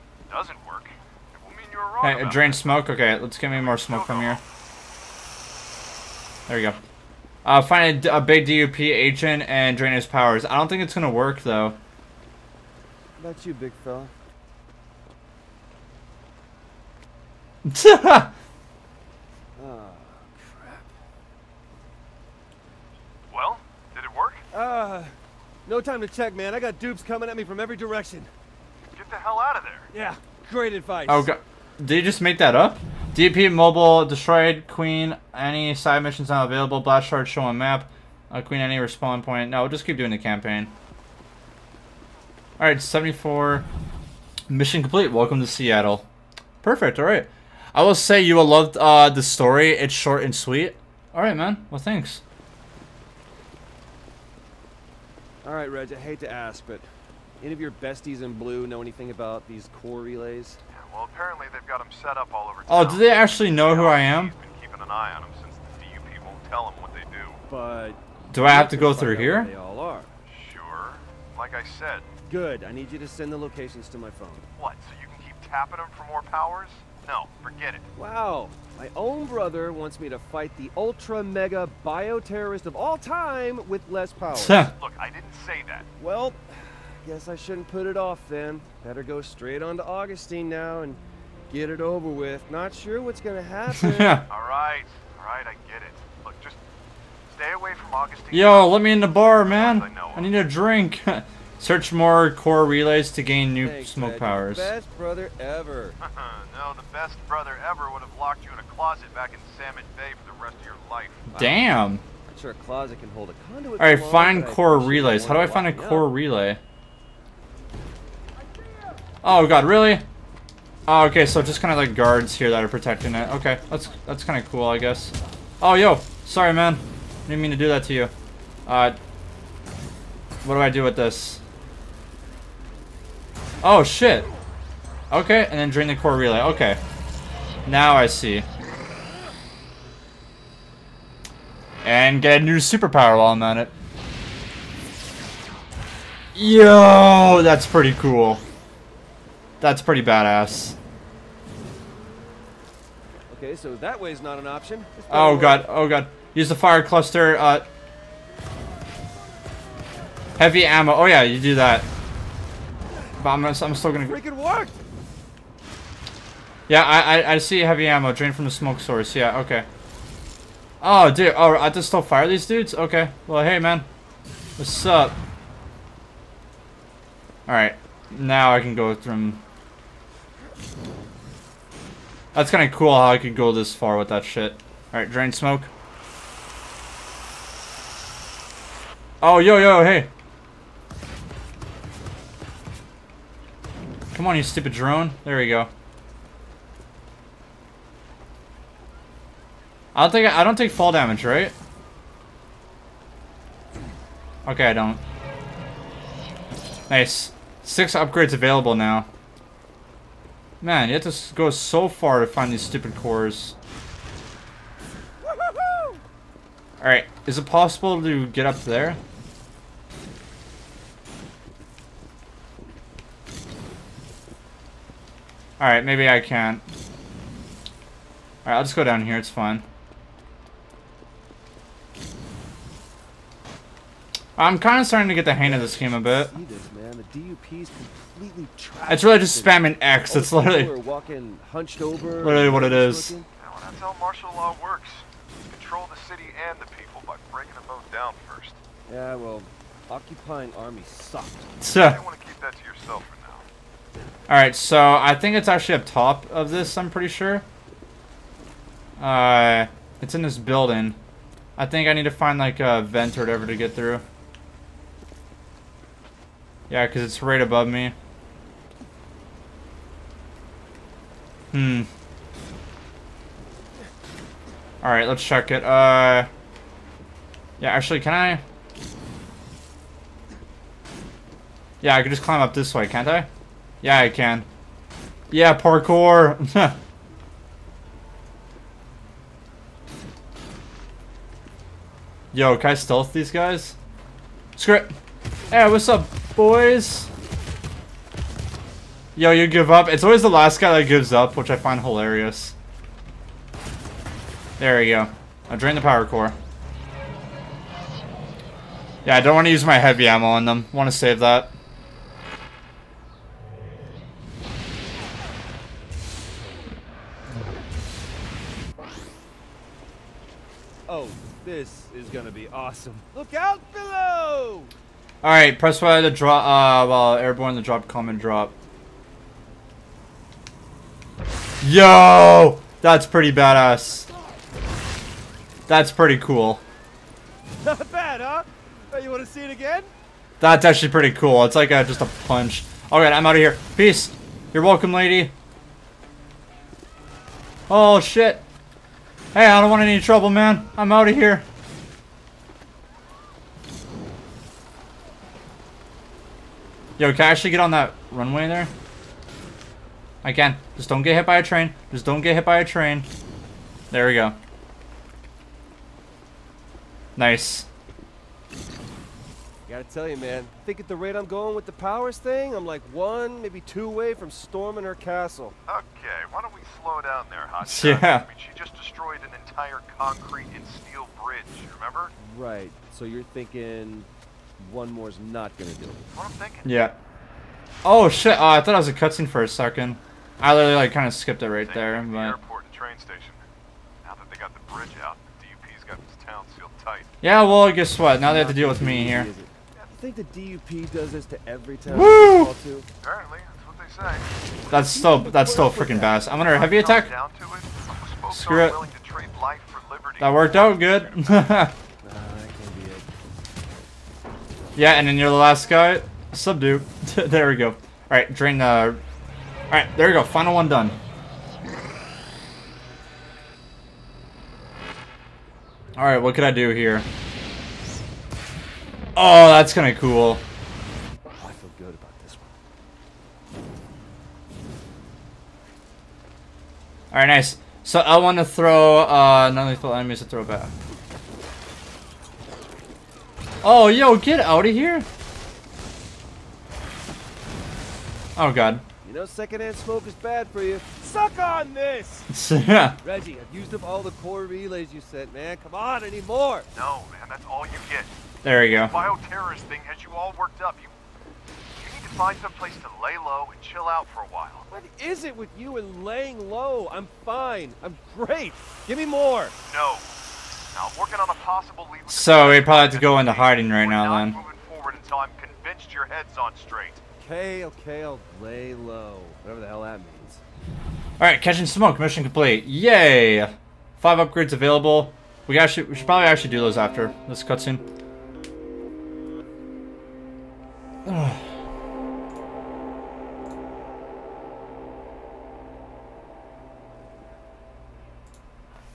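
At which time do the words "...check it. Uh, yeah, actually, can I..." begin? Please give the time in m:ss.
4:35.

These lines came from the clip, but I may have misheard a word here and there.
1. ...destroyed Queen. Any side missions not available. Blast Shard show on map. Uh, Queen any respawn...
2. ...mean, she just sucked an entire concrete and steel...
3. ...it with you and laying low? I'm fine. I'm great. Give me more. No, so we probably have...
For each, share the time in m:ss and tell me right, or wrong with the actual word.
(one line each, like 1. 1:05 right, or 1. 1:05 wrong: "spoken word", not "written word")
1. 0:34 right
2. 6:18 wrong: "destroyed", not "sucked"
3. 7:45 right.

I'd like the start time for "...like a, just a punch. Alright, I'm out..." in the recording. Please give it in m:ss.
5:41.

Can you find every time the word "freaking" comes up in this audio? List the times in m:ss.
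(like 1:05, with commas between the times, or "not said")
2:44, 6:45.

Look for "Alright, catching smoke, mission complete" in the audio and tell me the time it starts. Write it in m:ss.
8:01.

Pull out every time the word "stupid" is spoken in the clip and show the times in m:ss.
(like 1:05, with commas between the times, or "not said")
3:14, 3:32.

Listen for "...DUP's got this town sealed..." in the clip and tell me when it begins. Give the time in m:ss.
6:35.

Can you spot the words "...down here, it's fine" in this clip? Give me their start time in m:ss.
3:48.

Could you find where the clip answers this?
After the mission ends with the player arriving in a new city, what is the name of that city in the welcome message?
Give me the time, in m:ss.
0:45.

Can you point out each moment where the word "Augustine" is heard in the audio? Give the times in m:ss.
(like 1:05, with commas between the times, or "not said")
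1:29, 1:37.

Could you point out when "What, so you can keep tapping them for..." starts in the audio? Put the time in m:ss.
1:14.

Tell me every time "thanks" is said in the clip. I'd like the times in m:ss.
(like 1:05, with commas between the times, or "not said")
0:51, 1:43.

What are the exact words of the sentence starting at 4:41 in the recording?
Yeah, I could just climb up this way, can't I?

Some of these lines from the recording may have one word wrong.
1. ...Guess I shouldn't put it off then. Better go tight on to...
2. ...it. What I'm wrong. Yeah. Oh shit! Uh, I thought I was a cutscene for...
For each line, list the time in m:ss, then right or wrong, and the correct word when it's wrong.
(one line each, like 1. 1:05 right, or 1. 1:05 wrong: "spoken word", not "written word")
1. 1:27 wrong: "straight", not "tight"
2. 6:25 wrong: "thinking", not "wrong".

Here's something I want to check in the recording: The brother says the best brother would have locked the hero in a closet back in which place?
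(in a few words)
Salmon Bay.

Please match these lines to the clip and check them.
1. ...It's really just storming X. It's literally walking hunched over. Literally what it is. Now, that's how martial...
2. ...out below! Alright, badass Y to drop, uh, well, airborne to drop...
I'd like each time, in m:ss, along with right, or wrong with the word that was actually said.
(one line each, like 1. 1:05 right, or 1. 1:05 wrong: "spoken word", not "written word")
1. 3:58 wrong: "spamming", not "storming"
2. 5:23 wrong: "press", not "badass".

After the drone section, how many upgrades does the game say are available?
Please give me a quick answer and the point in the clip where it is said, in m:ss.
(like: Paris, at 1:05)
Six, at 3:27.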